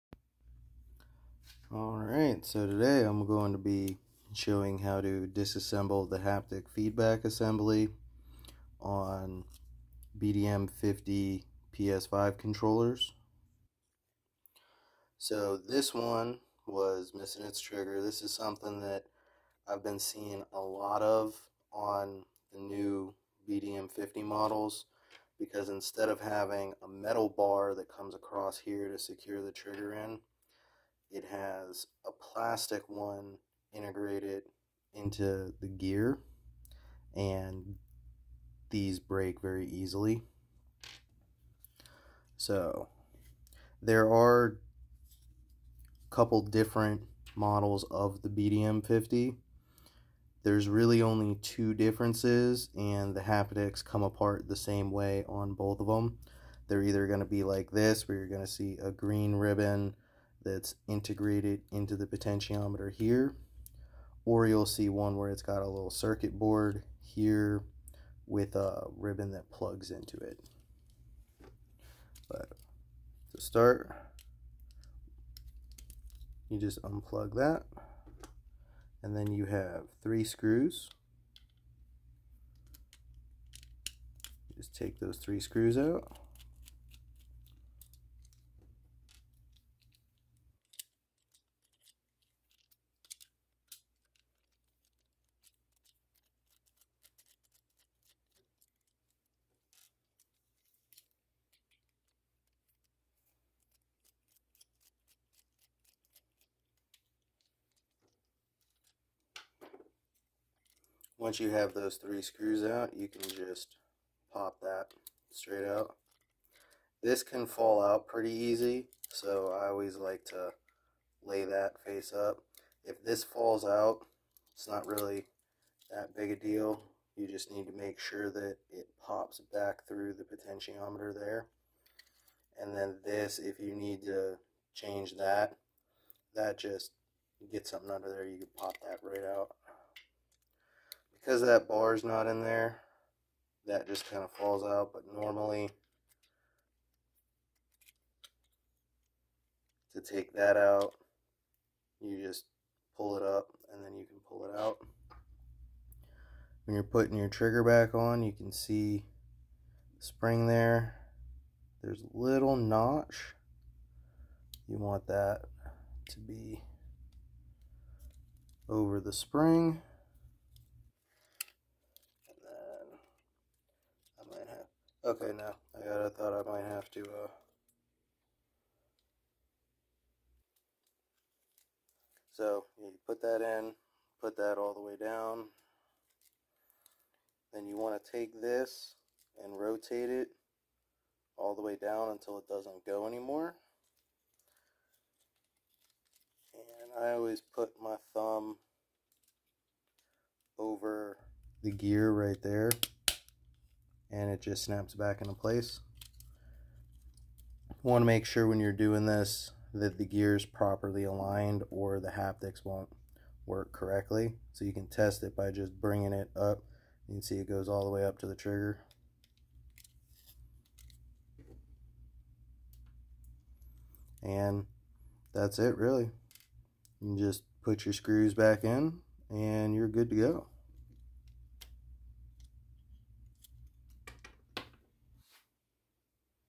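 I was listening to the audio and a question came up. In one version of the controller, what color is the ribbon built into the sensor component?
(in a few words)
green.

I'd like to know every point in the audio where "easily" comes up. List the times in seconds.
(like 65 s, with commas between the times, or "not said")
39 s.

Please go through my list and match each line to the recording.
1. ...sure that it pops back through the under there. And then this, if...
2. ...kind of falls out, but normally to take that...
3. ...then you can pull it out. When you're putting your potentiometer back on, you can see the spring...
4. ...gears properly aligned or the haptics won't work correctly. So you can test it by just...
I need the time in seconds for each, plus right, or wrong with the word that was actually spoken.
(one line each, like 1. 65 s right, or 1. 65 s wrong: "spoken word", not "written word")
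1. 127 s wrong: "potentiometer", not "under"
2. 144 s right
3. 153 s wrong: "trigger", not "potentiometer"
4. 210 s right.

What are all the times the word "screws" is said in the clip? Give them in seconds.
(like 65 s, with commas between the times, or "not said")
80 s, 85 s, 112 s, 227 s.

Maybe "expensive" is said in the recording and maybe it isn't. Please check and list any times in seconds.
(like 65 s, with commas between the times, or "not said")
not said.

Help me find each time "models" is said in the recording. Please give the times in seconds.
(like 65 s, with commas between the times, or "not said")
24 s, 47 s.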